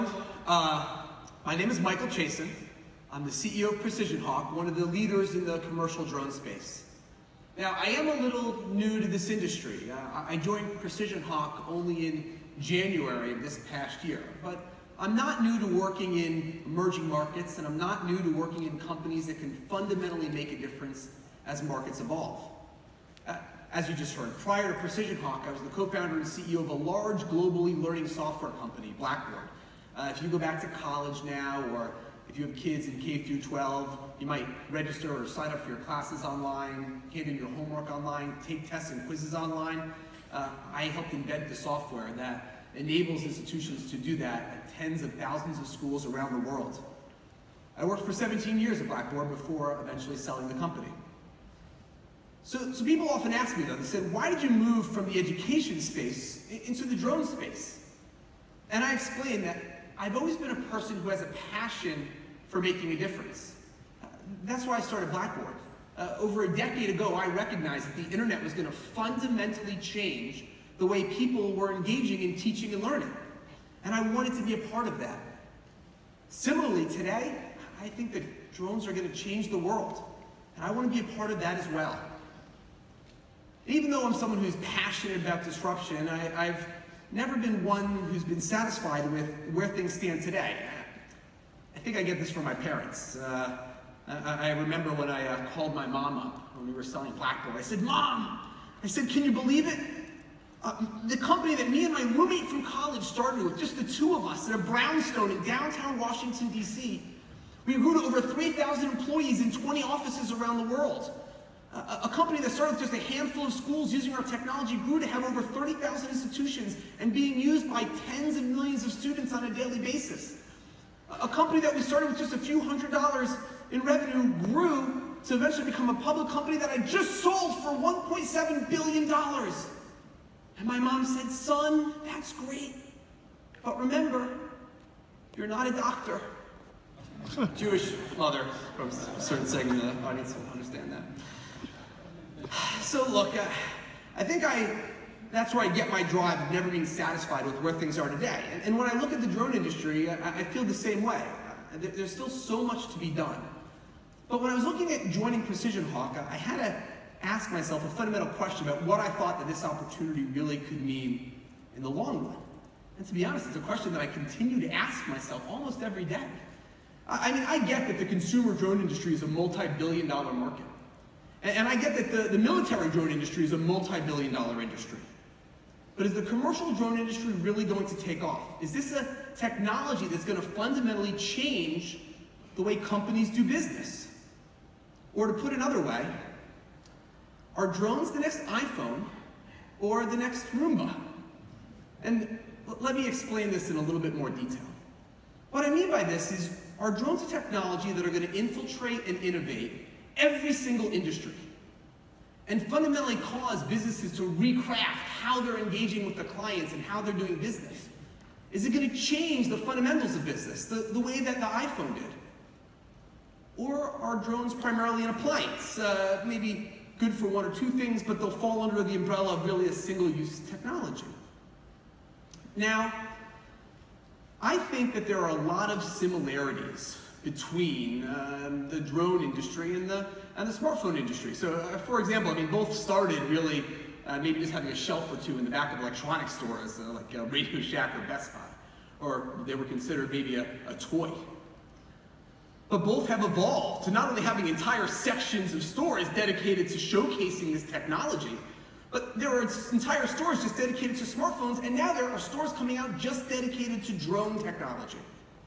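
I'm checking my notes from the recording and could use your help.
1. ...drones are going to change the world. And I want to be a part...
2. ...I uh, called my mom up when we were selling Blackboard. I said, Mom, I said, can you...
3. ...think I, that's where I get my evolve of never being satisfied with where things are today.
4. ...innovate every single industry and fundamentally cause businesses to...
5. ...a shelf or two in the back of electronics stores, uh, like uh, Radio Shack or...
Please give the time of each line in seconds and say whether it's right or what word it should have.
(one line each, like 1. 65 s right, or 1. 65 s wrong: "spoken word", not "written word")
1. 78 s right
2. 95 s right
3. 144 s wrong: "drive", not "evolve"
4. 199 s right
5. 234 s right.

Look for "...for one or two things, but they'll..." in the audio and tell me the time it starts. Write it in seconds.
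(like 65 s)
217 s.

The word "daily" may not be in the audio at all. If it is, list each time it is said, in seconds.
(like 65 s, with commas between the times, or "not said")
119 s.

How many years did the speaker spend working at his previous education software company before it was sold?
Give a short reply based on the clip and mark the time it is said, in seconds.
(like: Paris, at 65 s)
17, at 48 s.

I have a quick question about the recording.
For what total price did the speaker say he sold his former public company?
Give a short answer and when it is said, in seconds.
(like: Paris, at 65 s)
$1.7 billion, at 127 s.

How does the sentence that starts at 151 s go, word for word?
Uh, there's still so much to be done.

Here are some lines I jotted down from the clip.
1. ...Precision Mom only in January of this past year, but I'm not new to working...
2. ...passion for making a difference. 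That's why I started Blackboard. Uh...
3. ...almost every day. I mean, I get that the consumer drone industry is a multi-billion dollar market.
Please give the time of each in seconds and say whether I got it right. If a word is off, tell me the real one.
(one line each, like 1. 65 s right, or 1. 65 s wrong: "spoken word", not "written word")
1. 10 s wrong: "Hawk", not "Mom"
2. 61 s right
3. 165 s right.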